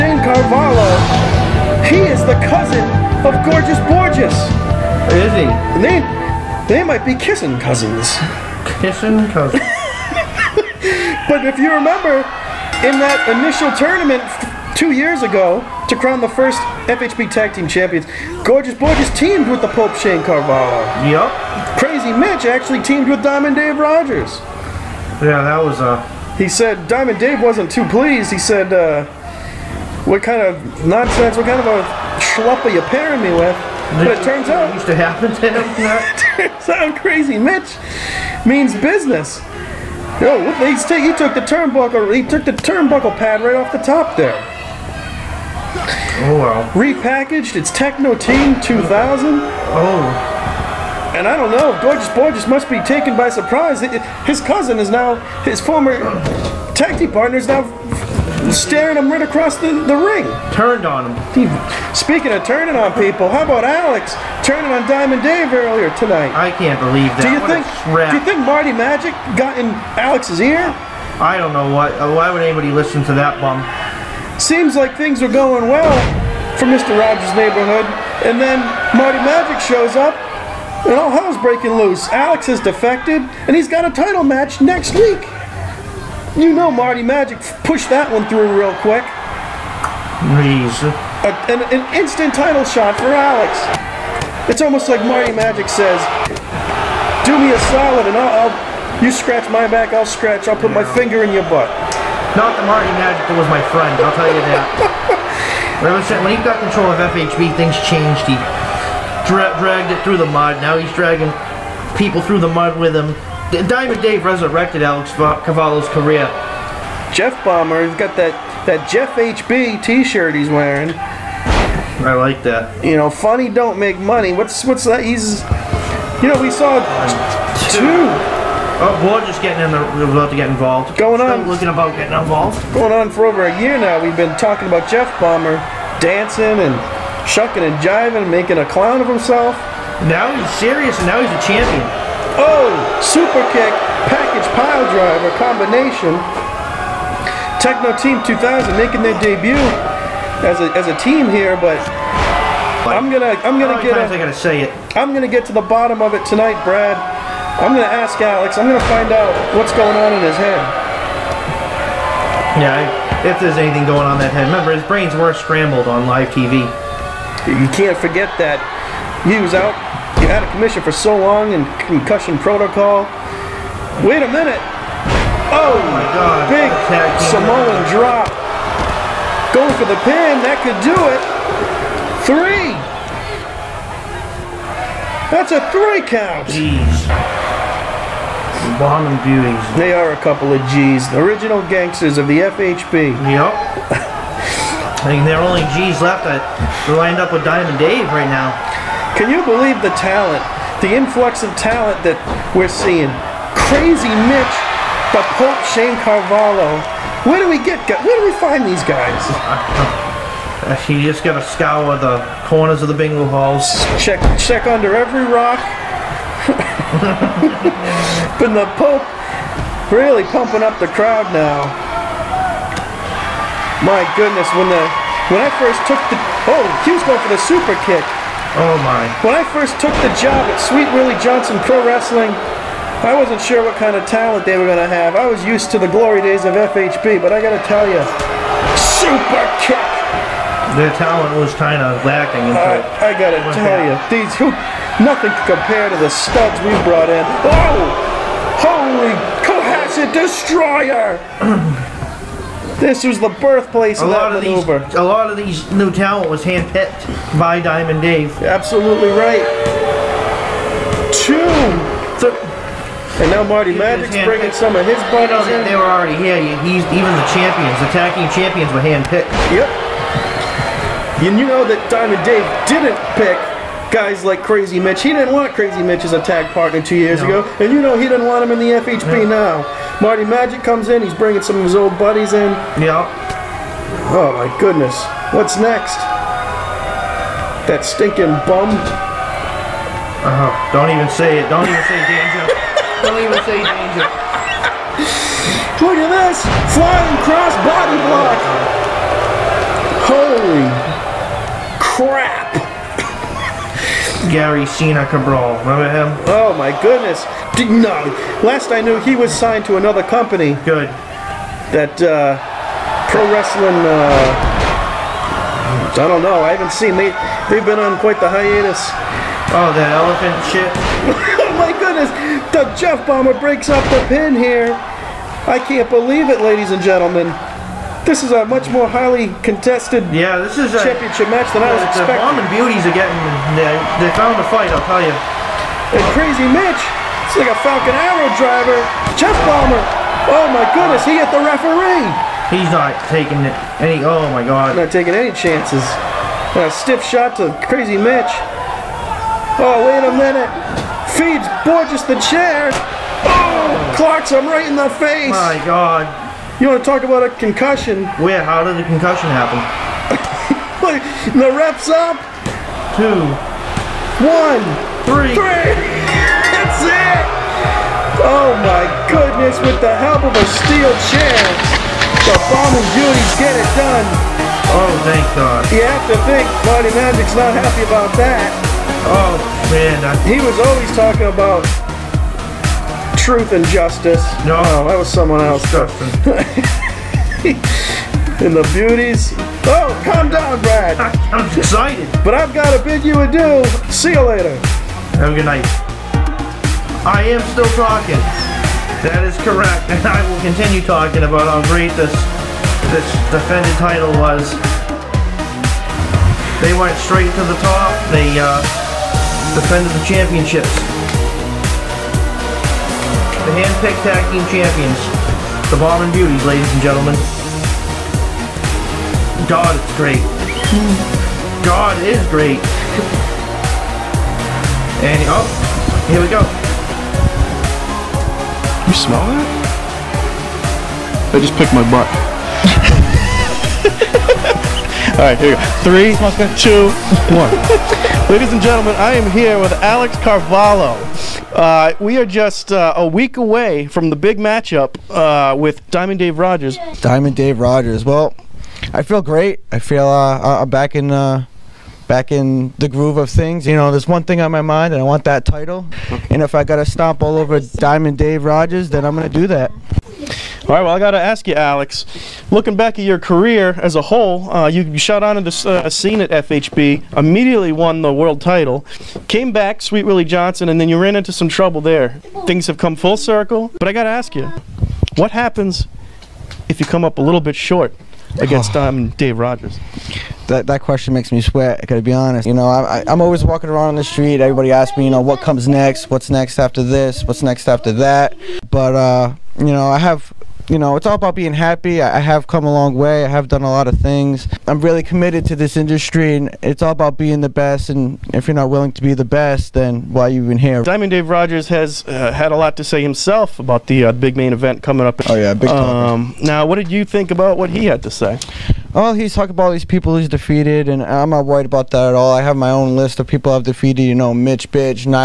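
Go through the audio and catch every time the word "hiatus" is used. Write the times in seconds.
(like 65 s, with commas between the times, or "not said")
318 s.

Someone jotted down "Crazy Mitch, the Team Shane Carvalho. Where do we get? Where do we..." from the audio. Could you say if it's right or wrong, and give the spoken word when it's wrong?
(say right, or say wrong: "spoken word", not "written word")
wrong: "Pope", not "Team".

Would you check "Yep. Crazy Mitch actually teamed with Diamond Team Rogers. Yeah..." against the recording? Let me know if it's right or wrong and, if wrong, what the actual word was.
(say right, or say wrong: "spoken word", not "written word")
wrong: "Dave", not "Team".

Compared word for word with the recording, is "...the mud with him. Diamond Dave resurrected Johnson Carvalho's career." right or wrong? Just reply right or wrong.
wrong.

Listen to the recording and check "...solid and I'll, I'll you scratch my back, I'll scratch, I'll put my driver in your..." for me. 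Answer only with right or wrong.
wrong.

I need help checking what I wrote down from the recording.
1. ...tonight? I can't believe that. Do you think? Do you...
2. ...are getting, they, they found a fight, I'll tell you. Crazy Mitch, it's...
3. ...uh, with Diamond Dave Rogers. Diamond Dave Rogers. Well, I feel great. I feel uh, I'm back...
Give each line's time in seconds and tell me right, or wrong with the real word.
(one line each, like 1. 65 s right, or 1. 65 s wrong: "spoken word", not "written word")
1. 65 s right
2. 332 s right
3. 445 s right.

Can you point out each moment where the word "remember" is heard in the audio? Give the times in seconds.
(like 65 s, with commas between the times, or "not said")
11 s, 164 s, 305 s.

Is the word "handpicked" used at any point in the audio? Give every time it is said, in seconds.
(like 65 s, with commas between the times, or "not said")
256 s, 268 s.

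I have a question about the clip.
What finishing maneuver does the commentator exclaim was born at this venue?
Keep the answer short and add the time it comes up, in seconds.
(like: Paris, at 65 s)
Cohasset Destroyer, at 249 s.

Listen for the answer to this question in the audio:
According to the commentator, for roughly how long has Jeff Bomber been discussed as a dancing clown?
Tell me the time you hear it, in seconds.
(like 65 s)
133 s.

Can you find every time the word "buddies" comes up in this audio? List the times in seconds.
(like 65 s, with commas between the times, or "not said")
265 s, 281 s.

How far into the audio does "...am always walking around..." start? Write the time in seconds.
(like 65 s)
483 s.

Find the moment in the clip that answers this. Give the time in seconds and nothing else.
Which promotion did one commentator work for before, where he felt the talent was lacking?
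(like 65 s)
230 s.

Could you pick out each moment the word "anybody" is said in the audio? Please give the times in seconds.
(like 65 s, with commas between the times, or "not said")
72 s.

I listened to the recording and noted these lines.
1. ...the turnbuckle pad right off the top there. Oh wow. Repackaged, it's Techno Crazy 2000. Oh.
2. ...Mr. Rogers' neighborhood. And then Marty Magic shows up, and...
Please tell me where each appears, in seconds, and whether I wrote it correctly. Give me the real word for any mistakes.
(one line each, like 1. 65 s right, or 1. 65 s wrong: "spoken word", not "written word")
1. 42 s wrong: "Team", not "Crazy"
2. 76 s right.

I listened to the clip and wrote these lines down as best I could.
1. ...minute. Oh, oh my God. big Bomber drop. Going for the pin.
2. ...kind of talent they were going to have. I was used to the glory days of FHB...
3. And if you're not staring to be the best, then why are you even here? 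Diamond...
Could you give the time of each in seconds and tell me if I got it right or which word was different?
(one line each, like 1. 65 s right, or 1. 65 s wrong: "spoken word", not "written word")
1. 174 s wrong: "Samoan", not "Bomber"
2. 233 s right
3. 497 s wrong: "willing", not "staring".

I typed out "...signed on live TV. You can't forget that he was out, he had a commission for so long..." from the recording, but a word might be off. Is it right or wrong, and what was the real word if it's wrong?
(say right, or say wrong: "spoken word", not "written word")
wrong: "scrambled", not "signed".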